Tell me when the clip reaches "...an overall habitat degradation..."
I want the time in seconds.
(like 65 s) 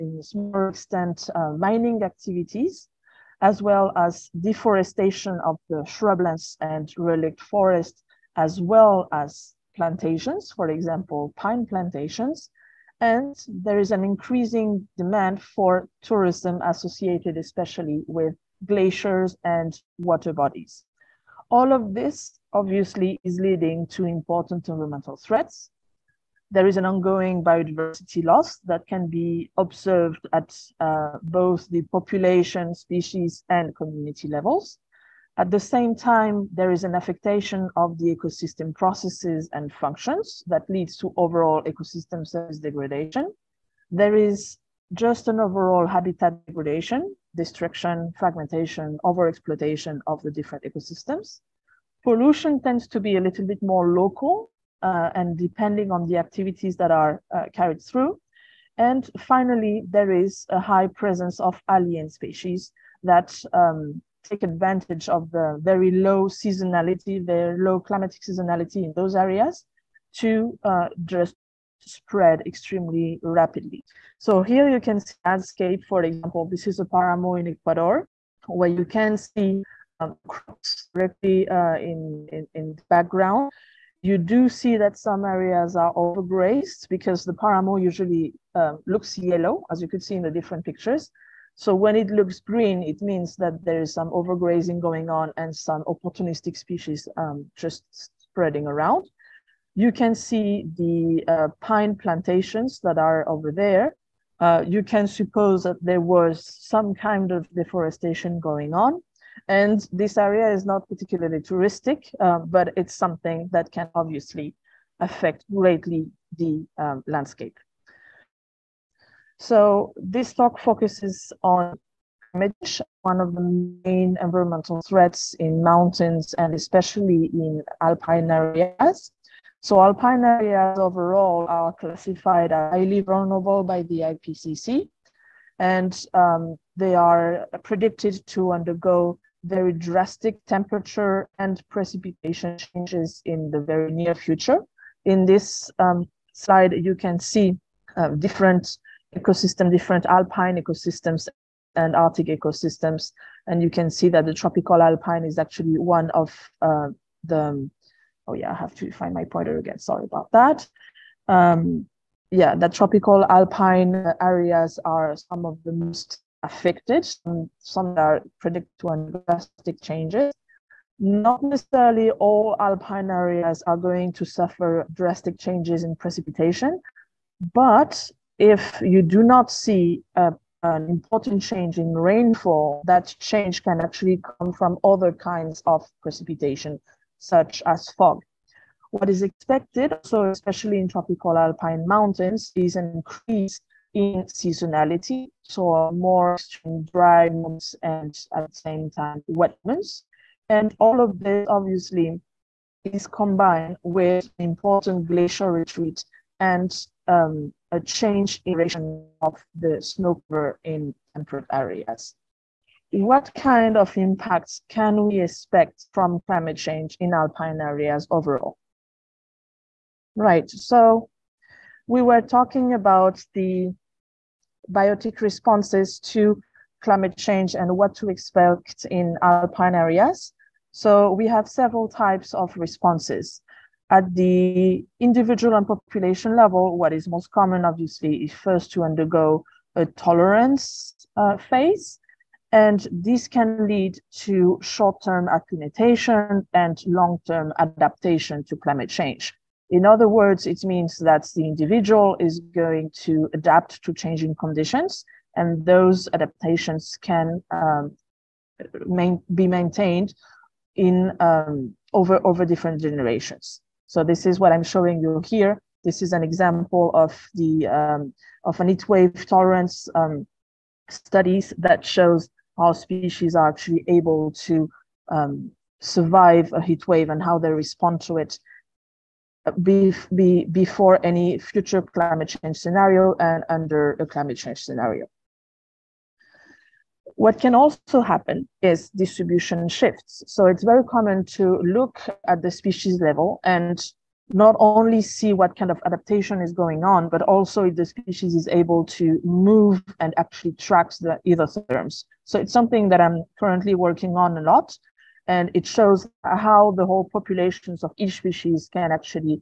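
45 s.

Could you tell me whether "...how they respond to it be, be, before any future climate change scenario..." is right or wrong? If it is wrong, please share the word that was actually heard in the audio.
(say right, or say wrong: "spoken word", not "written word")
right.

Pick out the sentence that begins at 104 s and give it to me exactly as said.
Uh, you can suppose that there was some kind of deforestation going on.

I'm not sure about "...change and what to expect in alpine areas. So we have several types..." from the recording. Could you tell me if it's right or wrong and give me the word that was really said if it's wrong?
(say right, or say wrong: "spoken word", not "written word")
right.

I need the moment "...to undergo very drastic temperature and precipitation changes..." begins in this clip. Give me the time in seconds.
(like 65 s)
138 s.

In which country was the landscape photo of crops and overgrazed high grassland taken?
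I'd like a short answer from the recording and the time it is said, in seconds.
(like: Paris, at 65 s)
Ecuador, at 77 s.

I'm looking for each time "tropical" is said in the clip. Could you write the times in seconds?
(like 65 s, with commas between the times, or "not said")
154 s, 162 s, 190 s.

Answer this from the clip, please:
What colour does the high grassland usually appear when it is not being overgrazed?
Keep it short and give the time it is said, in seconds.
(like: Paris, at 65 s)
Yellow, at 88 s.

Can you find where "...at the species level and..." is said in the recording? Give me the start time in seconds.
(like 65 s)
292 s.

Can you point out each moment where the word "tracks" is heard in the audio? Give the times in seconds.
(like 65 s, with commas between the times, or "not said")
300 s.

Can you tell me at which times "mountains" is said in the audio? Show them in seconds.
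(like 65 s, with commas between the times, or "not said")
125 s, 191 s.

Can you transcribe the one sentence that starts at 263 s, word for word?
So this is what I'm showing you here.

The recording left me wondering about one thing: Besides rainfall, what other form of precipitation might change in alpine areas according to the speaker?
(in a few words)
Fog.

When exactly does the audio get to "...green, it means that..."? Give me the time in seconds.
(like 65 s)
92 s.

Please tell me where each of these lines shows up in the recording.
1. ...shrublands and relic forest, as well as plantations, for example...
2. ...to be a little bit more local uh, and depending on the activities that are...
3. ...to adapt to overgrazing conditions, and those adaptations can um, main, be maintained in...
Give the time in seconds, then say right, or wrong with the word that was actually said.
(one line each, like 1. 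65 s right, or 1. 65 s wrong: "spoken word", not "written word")
1. 5 s right
2. 52 s right
3. 253 s wrong: "changing", not "overgrazing".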